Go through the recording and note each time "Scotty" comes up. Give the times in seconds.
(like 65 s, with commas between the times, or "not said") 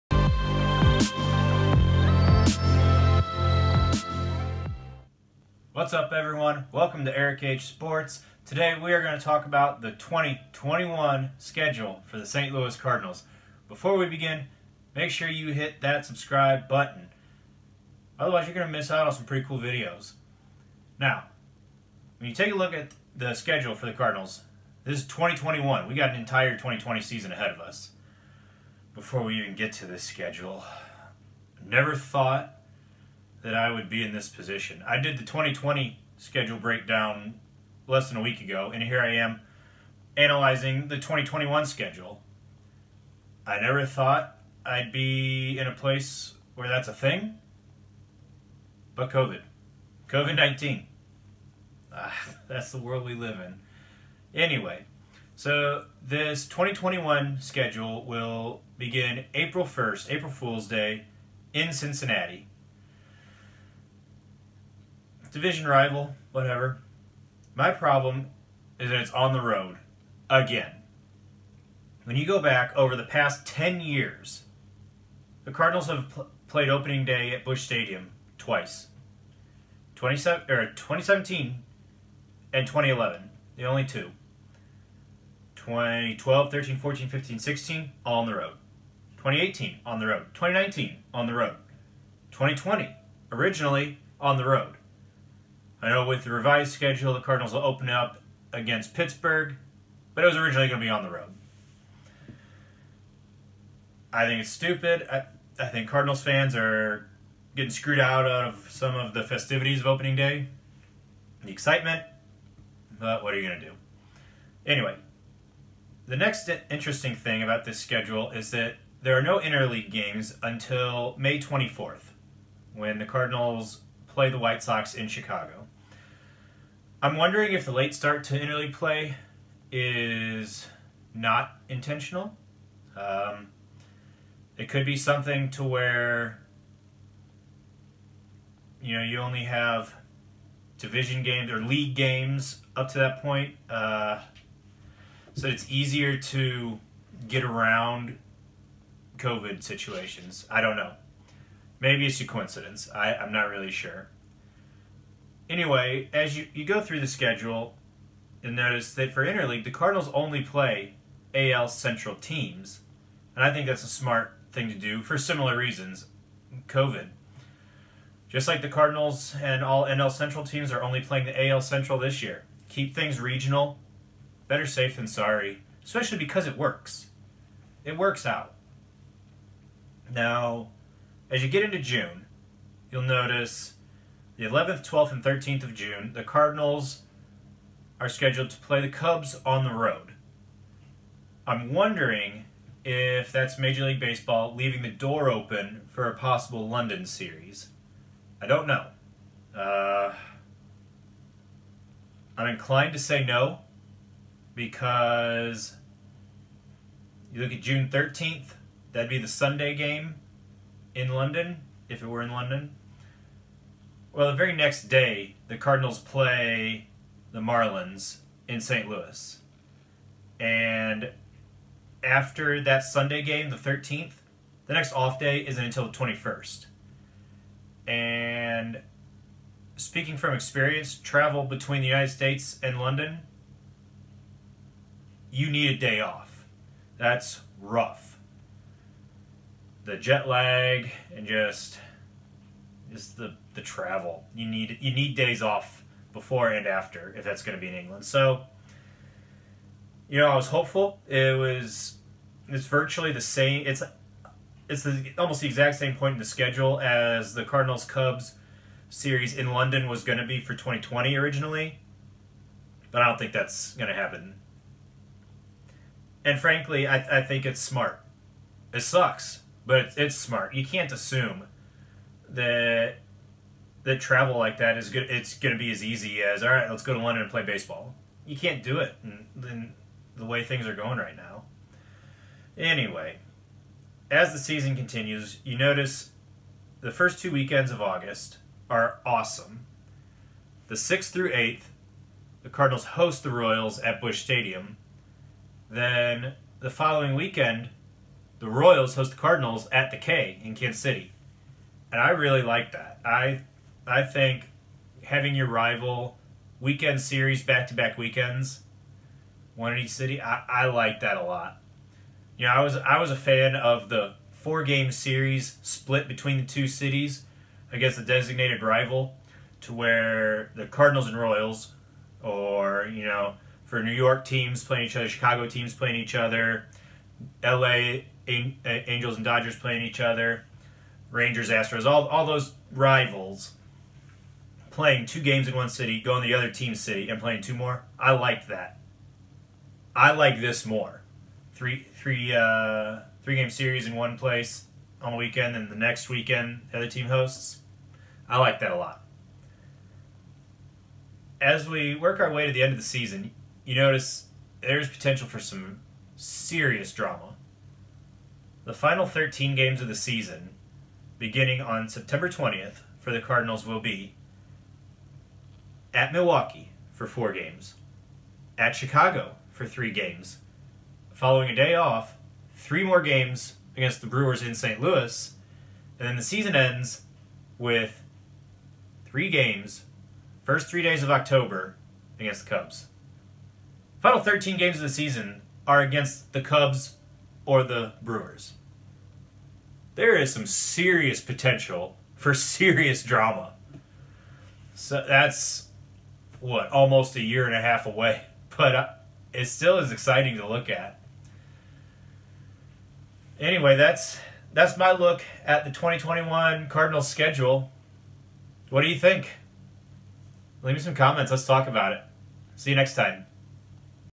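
not said.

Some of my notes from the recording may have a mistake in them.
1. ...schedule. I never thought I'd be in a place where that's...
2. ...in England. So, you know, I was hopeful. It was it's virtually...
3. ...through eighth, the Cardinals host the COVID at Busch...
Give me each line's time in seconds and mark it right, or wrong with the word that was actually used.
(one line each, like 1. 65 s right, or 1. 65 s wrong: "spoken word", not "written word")
1. 41 s right
2. 247 s right
3. 291 s wrong: "Royals", not "COVID".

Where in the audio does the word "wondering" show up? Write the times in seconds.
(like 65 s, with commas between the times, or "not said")
127 s, 191 s.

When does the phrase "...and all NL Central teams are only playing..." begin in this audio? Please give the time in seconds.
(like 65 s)
169 s.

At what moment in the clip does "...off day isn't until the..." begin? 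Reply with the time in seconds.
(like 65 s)
224 s.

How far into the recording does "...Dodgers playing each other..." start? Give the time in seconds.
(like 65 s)
329 s.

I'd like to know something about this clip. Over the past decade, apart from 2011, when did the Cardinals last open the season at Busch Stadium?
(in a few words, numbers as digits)
2017.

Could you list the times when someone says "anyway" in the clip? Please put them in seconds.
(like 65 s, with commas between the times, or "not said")
54 s, 114 s, 155 s, 282 s, 403 s.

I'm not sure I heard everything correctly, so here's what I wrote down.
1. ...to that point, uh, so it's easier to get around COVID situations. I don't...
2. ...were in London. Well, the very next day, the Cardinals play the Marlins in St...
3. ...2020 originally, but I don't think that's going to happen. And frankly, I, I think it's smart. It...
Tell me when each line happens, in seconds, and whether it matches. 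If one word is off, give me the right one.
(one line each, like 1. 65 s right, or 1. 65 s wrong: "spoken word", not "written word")
1. 142 s right
2. 212 s right
3. 260 s right.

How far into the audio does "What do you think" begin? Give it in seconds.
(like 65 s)
408 s.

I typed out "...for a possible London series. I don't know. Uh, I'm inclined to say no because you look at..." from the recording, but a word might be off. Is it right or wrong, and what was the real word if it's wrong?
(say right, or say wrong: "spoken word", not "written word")
right.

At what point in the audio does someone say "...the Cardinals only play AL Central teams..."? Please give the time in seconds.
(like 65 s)
159 s.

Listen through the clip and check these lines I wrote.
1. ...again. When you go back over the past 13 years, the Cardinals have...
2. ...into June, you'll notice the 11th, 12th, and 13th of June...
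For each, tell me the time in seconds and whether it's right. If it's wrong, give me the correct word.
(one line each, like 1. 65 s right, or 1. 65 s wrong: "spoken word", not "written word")
1. 70 s wrong: "10", not "13"
2. 181 s right.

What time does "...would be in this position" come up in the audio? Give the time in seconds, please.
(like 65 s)
33 s.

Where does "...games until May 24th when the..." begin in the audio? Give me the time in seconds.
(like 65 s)
119 s.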